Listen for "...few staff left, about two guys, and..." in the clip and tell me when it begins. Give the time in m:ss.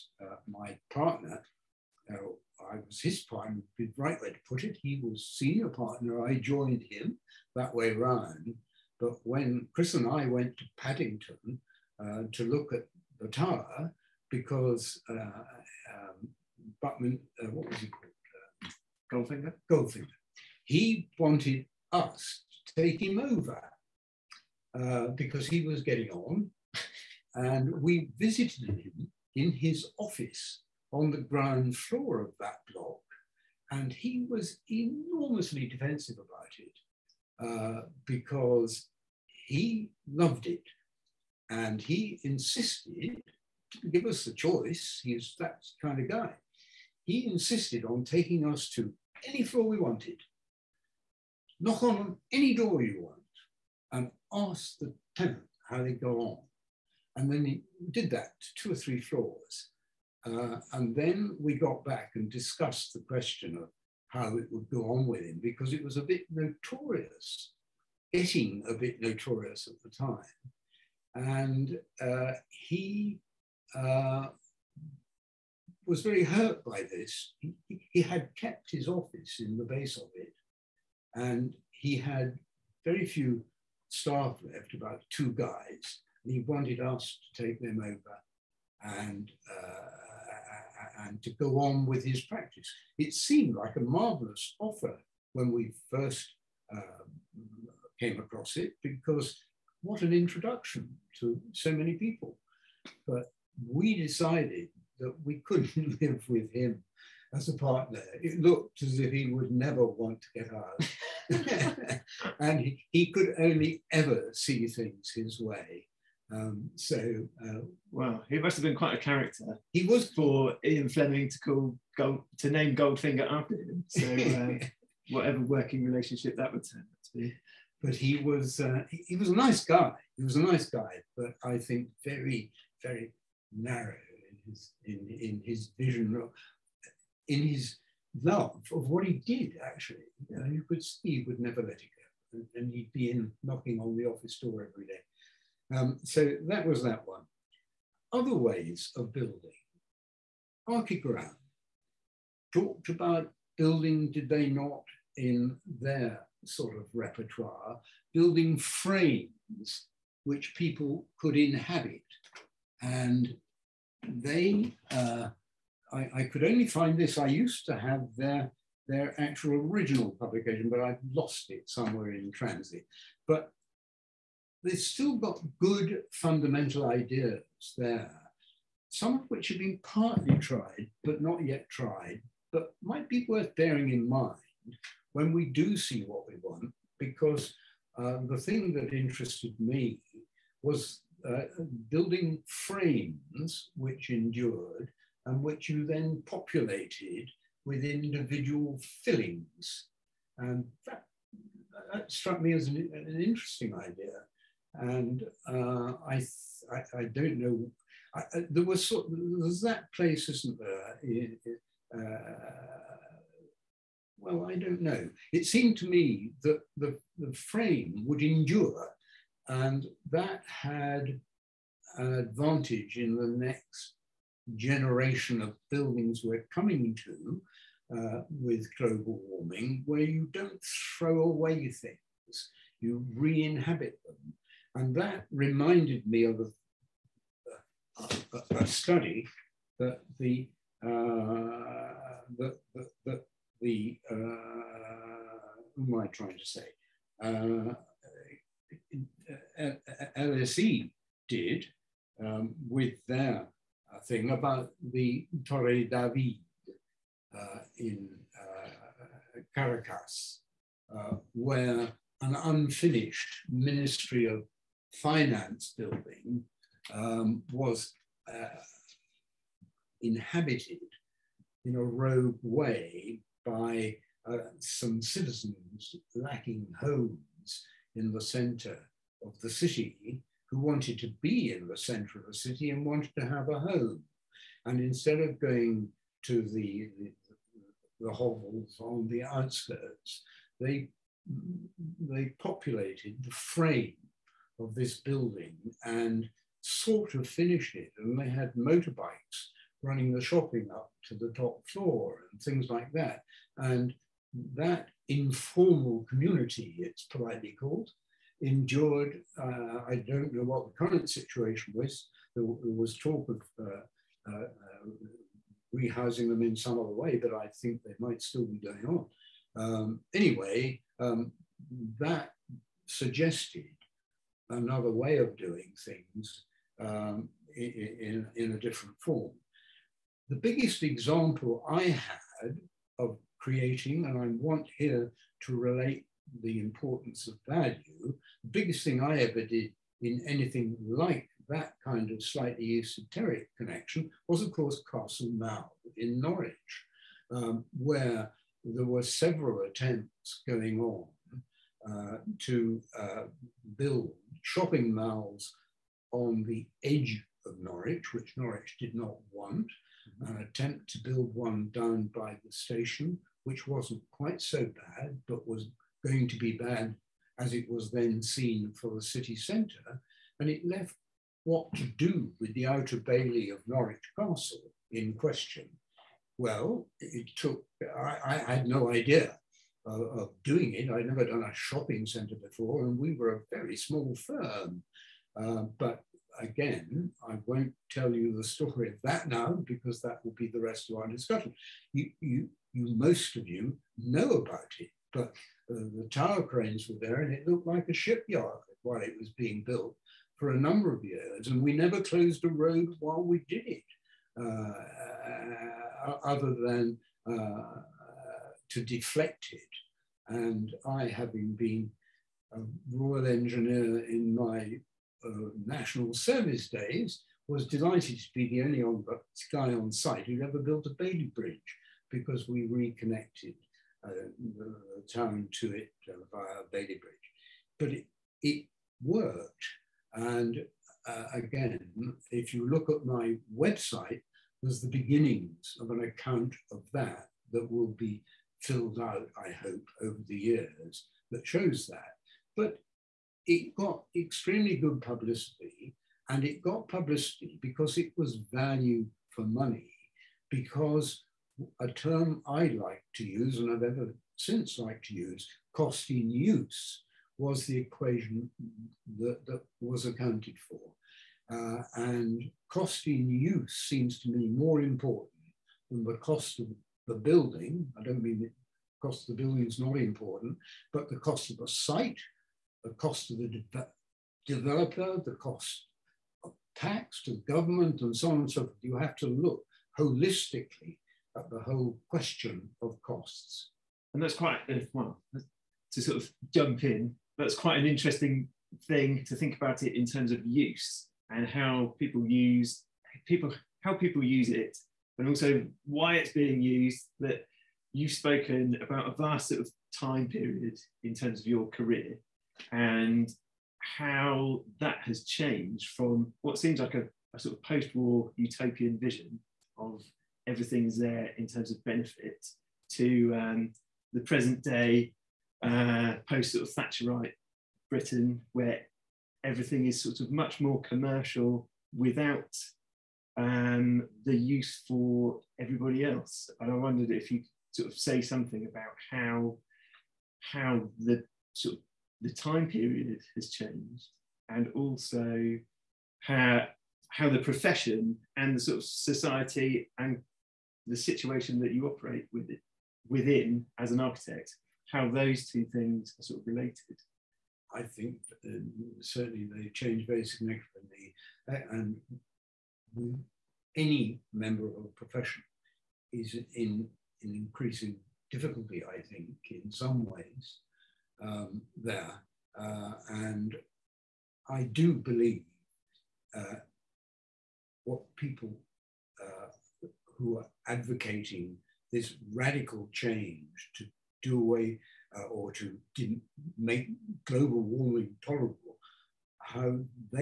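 1:23.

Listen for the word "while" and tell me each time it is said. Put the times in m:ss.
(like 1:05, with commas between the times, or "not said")
6:38, 6:42.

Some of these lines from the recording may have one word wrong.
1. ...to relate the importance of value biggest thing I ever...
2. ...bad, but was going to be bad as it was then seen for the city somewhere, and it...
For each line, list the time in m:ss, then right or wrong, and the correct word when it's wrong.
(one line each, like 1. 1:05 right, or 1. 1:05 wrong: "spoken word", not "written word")
1. 5:35 right
2. 6:04 wrong: "centre", not "somewhere".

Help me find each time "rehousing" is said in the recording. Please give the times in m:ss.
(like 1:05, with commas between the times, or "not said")
5:15.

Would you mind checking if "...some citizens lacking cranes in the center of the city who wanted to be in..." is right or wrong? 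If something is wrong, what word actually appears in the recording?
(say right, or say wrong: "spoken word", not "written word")
wrong: "homes", not "cranes".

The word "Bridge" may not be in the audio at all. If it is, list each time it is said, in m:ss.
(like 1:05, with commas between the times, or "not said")
7:01, 7:07.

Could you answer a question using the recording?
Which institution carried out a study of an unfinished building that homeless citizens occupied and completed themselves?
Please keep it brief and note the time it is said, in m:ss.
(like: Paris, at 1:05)
LSE, at 4:10.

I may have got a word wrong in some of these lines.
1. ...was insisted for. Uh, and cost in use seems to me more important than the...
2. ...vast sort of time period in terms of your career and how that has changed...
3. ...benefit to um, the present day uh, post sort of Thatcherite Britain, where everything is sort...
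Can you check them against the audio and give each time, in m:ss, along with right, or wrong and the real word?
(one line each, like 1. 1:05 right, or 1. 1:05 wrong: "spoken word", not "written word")
1. 7:39 wrong: "accounted", not "insisted"
2. 8:19 right
3. 8:31 right.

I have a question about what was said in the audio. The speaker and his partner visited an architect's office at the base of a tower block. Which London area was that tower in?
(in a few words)
Paddington.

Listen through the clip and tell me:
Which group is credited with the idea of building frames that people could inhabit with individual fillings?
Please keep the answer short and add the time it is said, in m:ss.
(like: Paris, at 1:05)
Archigram, at 2:30.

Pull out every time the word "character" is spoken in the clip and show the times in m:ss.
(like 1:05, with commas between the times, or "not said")
1:59.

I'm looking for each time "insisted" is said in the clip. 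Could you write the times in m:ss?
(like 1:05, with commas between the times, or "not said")
0:42, 0:47.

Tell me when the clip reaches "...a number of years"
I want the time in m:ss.
6:40.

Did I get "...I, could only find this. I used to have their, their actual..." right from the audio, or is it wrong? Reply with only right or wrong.
right.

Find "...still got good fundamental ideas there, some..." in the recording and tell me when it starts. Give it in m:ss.
2:54.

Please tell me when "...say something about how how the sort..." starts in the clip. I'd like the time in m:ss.
8:47.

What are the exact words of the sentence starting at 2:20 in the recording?
You, know, you could see he would never let it go.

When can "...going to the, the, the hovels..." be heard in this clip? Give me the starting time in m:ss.
4:45.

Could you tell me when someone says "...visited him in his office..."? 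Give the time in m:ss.
0:28.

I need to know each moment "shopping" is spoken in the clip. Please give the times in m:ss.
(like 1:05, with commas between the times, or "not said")
5:00, 5:54, 6:21.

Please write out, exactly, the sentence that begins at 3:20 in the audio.
And that, that struck me as an, an interesting idea.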